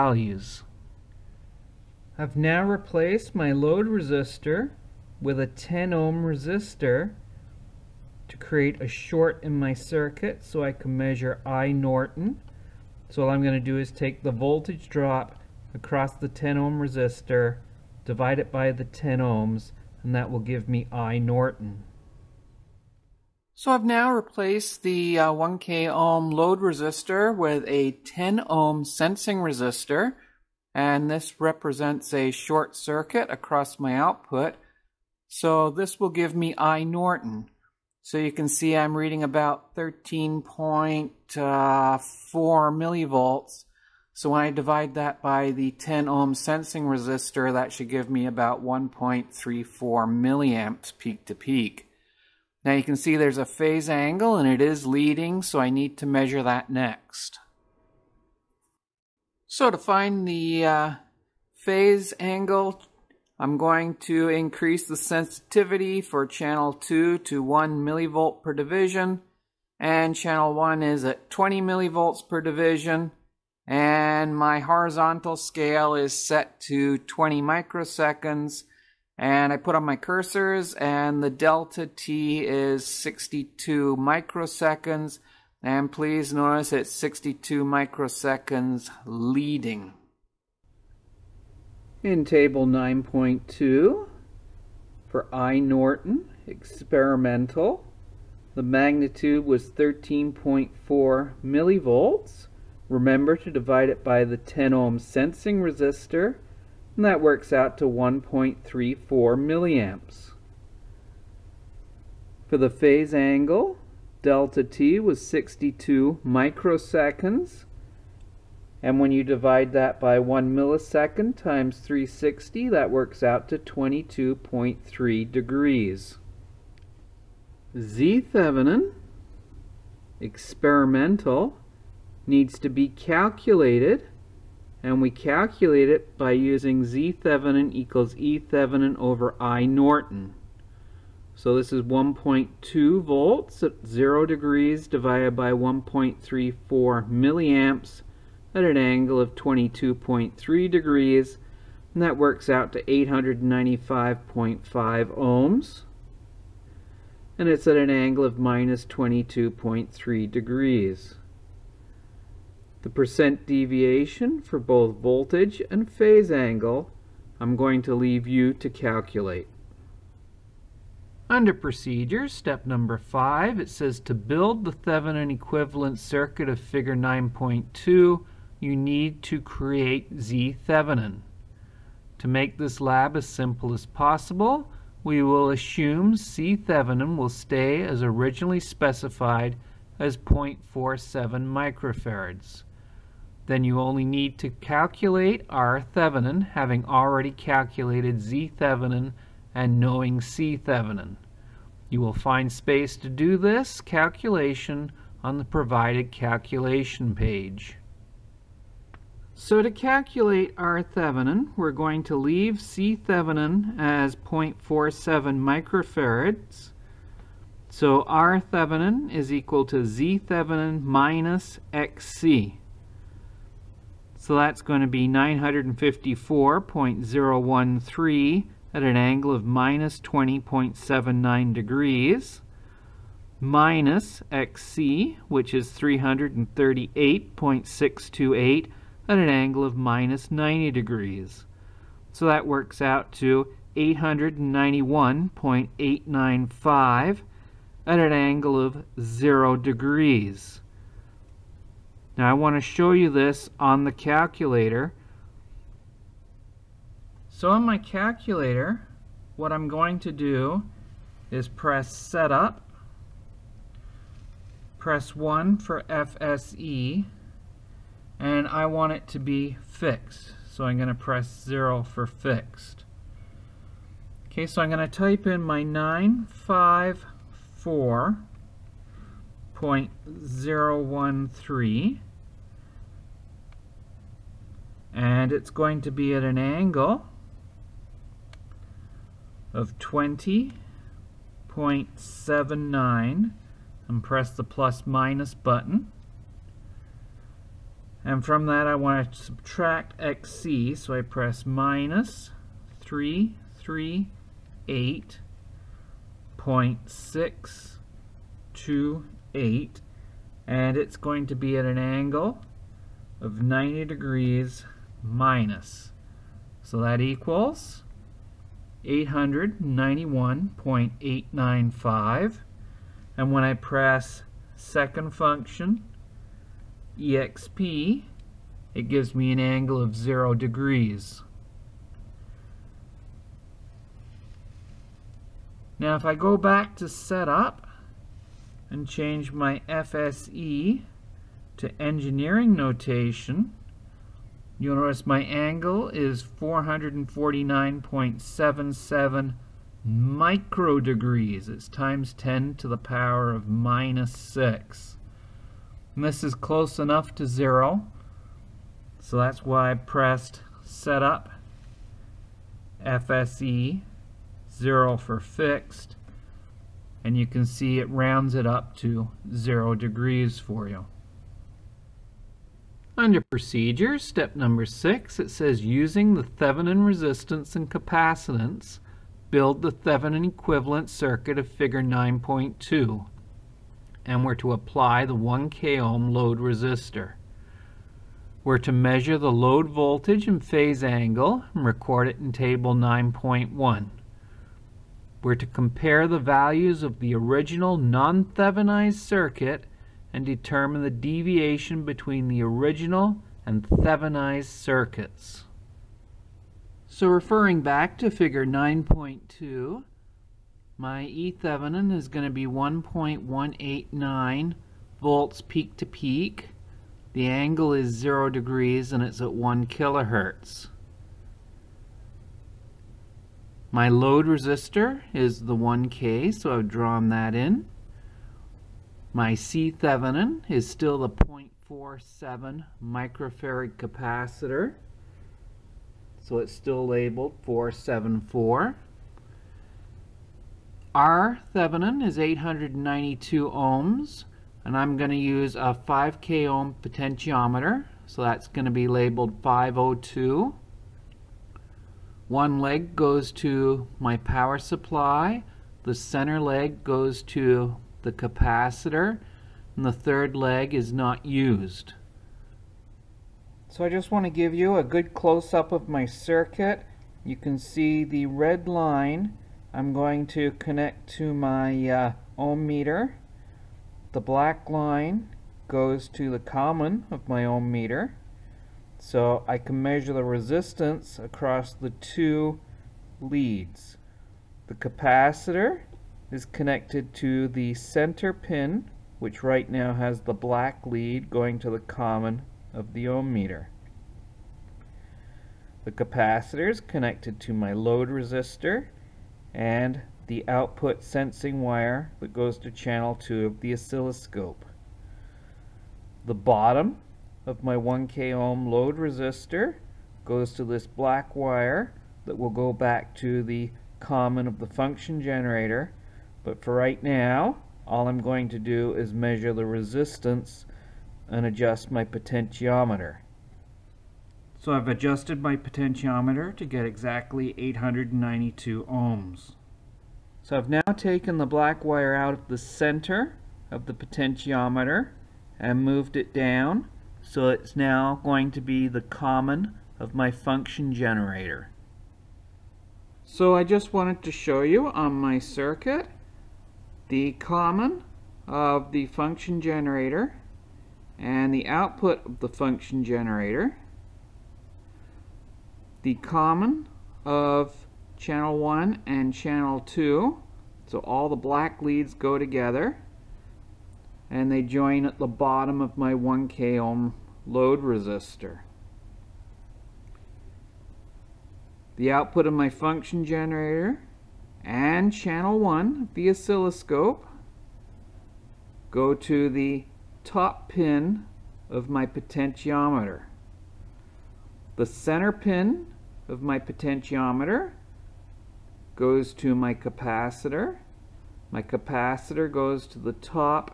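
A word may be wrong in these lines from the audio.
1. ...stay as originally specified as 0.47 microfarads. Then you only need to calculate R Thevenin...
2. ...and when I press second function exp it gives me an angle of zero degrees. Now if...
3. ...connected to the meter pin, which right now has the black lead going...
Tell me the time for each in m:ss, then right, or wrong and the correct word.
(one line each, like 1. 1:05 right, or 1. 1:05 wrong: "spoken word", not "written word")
1. 3:07 right
2. 5:23 right
3. 8:06 wrong: "center", not "meter".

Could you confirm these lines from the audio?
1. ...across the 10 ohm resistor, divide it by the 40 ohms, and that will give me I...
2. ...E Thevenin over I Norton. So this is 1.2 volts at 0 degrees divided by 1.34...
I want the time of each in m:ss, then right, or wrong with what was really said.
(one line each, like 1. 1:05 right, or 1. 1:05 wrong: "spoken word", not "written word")
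1. 0:15 wrong: "10", not "40"
2. 2:18 right.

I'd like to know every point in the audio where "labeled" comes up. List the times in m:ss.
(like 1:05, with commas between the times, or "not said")
7:16, 7:28.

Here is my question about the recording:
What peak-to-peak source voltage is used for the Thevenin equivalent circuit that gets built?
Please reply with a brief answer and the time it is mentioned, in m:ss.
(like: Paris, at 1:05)
1.189 volts, at 6:52.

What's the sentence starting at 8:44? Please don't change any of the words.
So I've adjusted my potentiometer to get exactly 892 ohms.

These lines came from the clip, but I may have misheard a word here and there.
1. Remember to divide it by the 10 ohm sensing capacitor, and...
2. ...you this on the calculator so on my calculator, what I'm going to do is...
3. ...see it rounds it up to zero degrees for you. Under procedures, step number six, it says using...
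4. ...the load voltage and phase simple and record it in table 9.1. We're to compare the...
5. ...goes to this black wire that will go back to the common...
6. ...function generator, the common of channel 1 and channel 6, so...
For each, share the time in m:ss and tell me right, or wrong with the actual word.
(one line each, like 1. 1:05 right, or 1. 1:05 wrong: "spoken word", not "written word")
1. 1:42 wrong: "resistor", not "capacitor"
2. 4:12 right
3. 6:07 right
4. 6:29 wrong: "angle", not "simple"
5. 8:30 right
6. 9:12 wrong: "2", not "6".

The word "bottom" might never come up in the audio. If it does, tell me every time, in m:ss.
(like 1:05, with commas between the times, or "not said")
8:26, 9:25.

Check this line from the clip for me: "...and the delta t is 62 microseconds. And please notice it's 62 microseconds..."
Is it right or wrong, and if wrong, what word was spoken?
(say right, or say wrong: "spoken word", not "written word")
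right.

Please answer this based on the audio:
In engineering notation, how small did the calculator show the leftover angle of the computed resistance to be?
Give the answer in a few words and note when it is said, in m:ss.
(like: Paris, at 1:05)
449.77 microdegrees, at 5:46.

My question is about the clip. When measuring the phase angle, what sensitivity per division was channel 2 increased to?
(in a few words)
1 millivolt per division.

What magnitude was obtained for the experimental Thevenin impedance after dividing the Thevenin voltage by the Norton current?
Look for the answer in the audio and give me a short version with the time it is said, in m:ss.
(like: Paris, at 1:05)
895.5 ohms, at 2:32.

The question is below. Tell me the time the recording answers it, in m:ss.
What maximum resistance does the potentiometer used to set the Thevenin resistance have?
7:25.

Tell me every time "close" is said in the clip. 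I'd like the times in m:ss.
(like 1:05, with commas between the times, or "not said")
5:56, 7:45.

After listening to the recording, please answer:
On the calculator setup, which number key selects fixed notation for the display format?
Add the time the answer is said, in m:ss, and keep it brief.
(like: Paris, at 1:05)
0, at 4:31.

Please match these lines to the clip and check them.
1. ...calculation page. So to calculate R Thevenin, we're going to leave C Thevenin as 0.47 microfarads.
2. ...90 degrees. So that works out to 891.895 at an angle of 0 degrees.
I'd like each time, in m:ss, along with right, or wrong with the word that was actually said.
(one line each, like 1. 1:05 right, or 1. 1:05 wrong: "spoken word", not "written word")
1. 3:26 right
2. 4:00 right.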